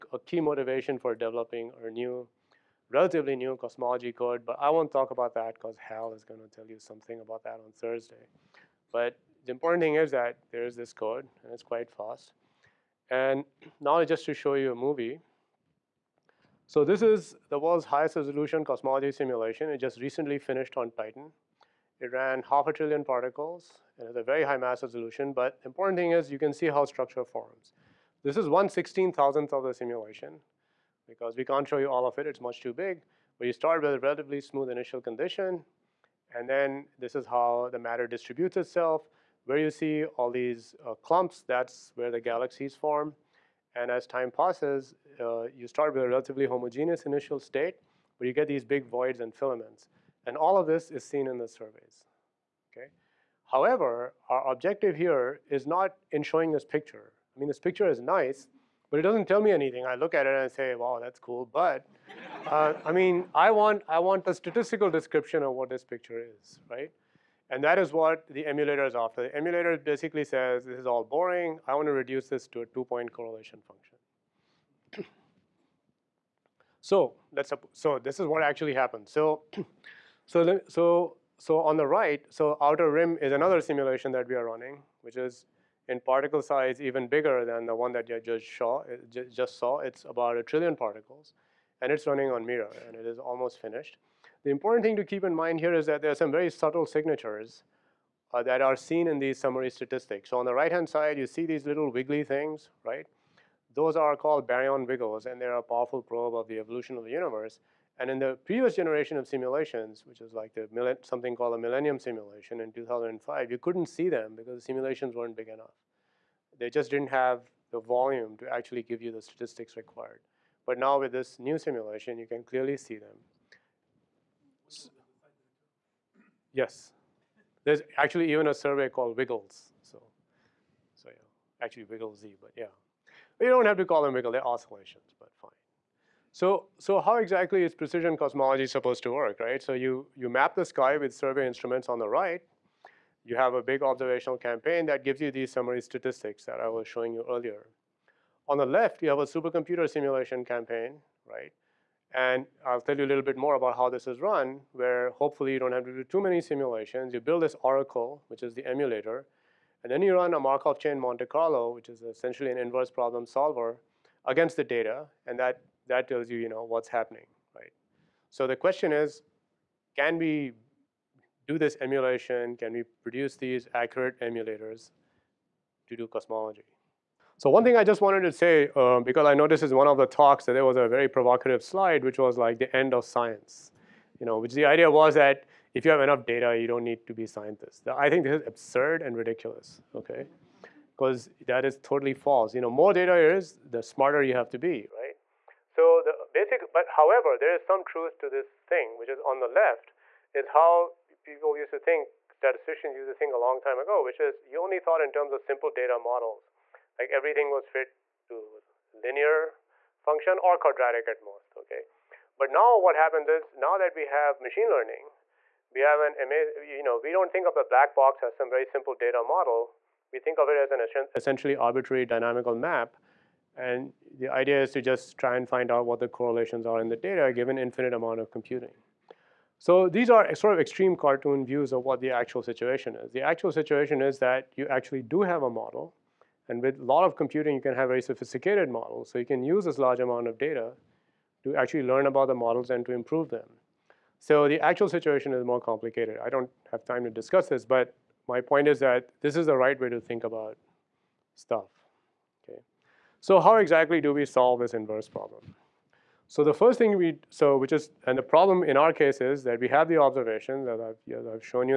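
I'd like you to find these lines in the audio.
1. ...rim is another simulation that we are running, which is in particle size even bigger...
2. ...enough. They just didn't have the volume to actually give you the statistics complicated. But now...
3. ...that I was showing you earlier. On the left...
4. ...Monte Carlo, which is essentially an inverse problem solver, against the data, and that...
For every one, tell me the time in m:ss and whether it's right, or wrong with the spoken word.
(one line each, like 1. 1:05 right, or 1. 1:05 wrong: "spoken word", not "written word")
1. 1:22 right
2. 1:55 wrong: "required", not "complicated"
3. 2:26 right
4. 2:40 right.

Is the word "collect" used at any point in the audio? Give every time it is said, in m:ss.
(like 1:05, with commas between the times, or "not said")
not said.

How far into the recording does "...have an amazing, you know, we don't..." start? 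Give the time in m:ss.
3:35.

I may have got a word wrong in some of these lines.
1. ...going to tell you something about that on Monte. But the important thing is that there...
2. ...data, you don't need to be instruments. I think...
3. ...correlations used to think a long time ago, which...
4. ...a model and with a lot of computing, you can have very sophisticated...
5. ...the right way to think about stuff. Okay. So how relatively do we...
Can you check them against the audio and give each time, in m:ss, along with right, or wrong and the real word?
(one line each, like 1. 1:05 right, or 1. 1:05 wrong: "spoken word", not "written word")
1. 0:06 wrong: "Thursday", not "Monte"
2. 3:06 wrong: "scientists", not "instruments"
3. 3:22 wrong: "statisticians", not "correlations"
4. 3:55 right
5. 4:09 wrong: "exactly", not "relatively".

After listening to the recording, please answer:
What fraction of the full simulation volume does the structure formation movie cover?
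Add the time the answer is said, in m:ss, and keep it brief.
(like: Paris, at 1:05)
1/16,000, at 0:28.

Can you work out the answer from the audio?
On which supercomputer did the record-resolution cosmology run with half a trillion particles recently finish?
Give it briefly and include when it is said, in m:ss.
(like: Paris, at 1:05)
Titan, at 0:20.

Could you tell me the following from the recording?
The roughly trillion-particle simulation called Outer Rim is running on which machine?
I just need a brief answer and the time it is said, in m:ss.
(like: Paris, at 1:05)
Mira, at 1:32.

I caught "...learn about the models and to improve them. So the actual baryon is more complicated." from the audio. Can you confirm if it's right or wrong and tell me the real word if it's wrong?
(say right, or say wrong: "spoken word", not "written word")
wrong: "situation", not "baryon".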